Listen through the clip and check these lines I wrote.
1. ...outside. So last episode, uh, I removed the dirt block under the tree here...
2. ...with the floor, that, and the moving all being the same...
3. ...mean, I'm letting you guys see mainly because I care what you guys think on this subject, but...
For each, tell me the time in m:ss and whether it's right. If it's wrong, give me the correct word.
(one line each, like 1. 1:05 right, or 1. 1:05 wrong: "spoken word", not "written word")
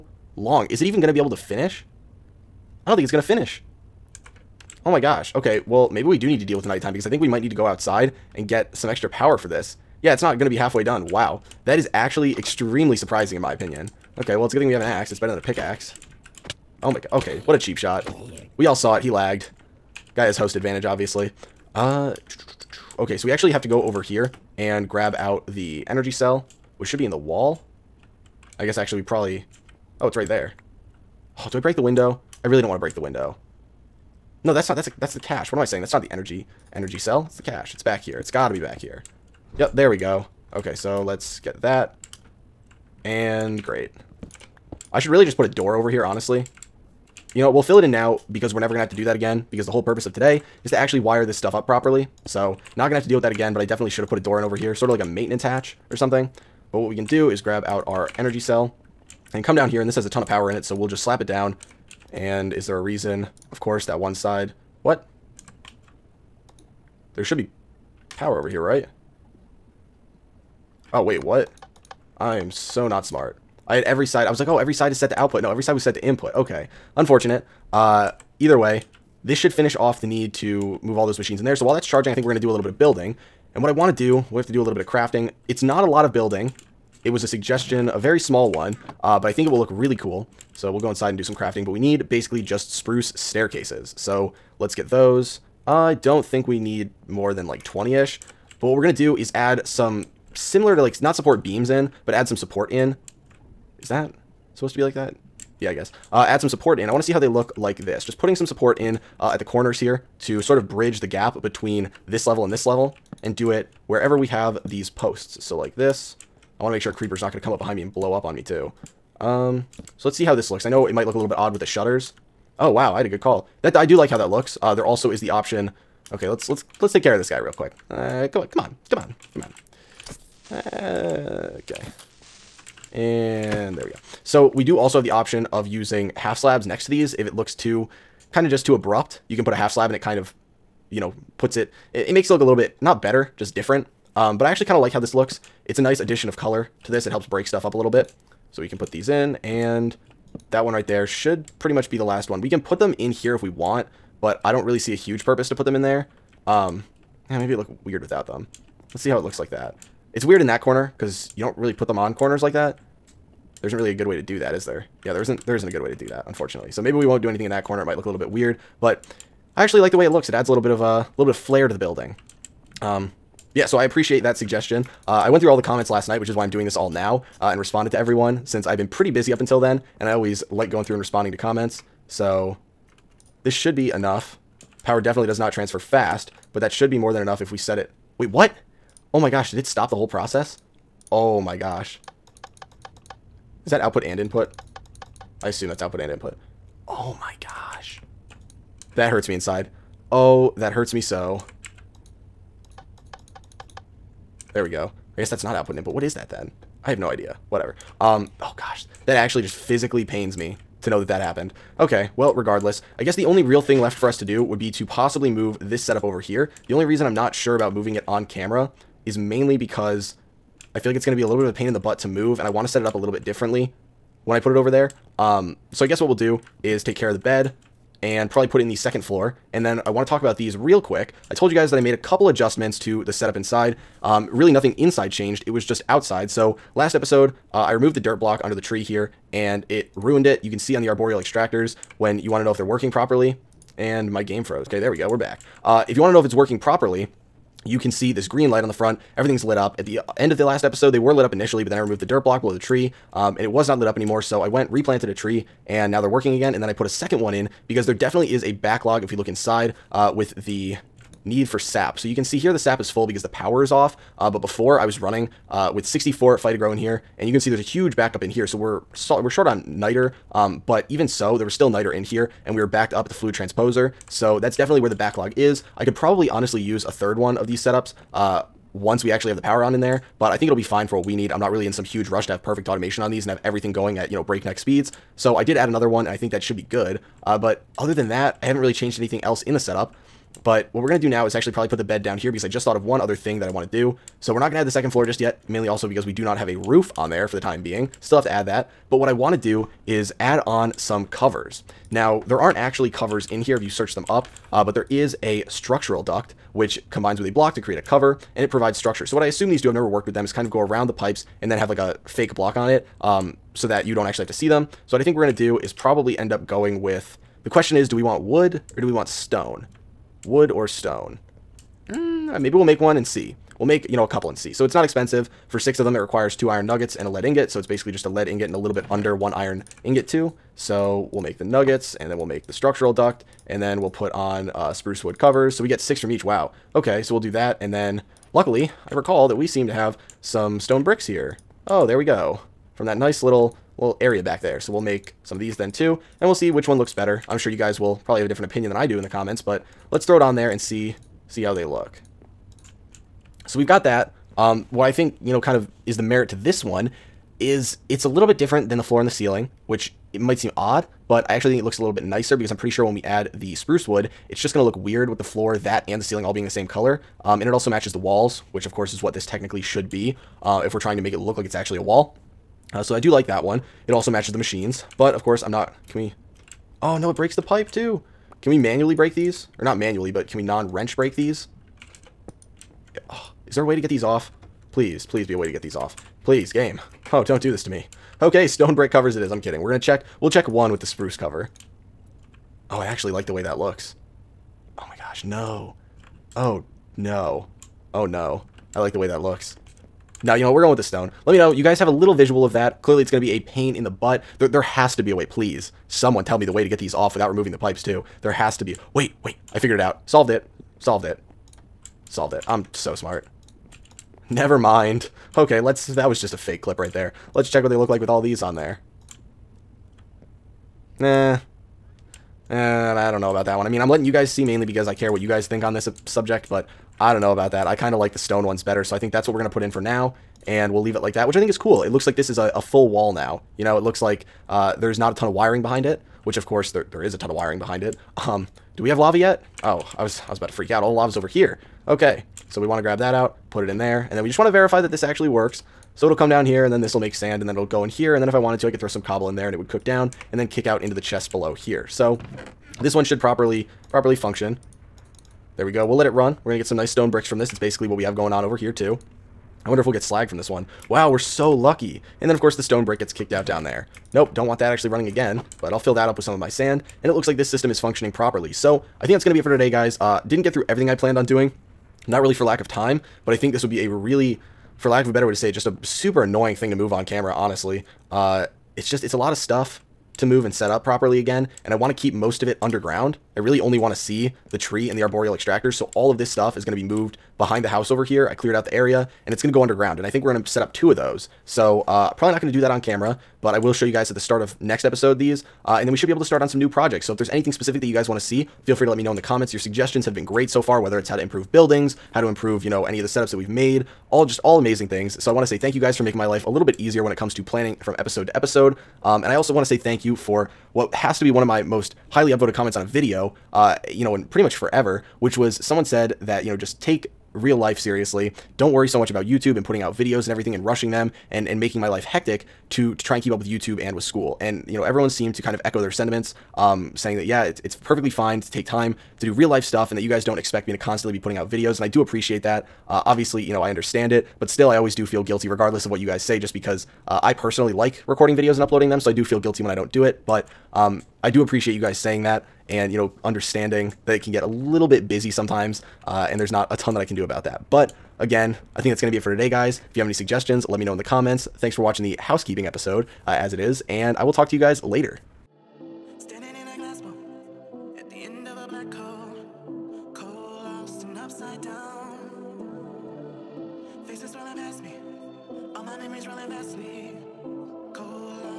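1. 3:55 right
2. 6:05 wrong: "ceiling", not "moving"
3. 7:03 right.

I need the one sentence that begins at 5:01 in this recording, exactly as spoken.
Now, there aren't actually covers in here if you search them up.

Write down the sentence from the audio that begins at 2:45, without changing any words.
Yeah, there isn't there isn't a good way to do that, unfortunately.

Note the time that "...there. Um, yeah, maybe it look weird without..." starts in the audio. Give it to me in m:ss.
2:35.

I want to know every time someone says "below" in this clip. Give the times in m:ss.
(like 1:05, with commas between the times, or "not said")
4:12, 7:31.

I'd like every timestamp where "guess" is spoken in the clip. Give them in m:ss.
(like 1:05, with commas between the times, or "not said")
0:28, 1:45, 3:25, 3:33, 3:45.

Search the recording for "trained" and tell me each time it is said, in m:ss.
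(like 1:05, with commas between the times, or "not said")
not said.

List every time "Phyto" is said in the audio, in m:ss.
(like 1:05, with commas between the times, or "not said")
4:26.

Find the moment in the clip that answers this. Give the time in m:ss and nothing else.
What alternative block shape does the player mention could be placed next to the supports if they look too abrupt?
2:16.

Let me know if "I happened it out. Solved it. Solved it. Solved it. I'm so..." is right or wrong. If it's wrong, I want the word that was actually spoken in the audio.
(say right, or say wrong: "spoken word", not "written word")
wrong: "figured", not "happened".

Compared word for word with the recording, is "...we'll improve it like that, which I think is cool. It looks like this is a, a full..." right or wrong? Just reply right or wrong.
wrong.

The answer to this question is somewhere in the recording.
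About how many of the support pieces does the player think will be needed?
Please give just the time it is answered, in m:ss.
1:37.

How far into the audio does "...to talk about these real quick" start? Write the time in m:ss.
3:50.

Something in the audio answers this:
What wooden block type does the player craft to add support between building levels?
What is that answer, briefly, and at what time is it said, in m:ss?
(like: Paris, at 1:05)
spruce staircases, at 1:32.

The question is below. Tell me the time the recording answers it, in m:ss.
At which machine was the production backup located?
4:33.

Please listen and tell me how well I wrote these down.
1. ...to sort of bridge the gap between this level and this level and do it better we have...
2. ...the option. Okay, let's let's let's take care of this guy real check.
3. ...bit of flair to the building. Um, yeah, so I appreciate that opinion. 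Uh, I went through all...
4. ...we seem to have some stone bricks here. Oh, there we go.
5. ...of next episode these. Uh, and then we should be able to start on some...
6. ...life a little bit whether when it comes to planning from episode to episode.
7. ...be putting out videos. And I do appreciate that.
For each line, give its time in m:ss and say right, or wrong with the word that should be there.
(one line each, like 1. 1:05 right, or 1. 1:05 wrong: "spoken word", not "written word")
1. 1:50 wrong: "wherever", not "better"
2. 2:05 wrong: "quick", not "check"
3. 2:51 wrong: "suggestion", not "opinion"
4. 5:39 right
5. 8:14 right
6. 8:26 wrong: "easier", not "whether"
7. 8:51 right.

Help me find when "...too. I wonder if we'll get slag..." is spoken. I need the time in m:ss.
7:38.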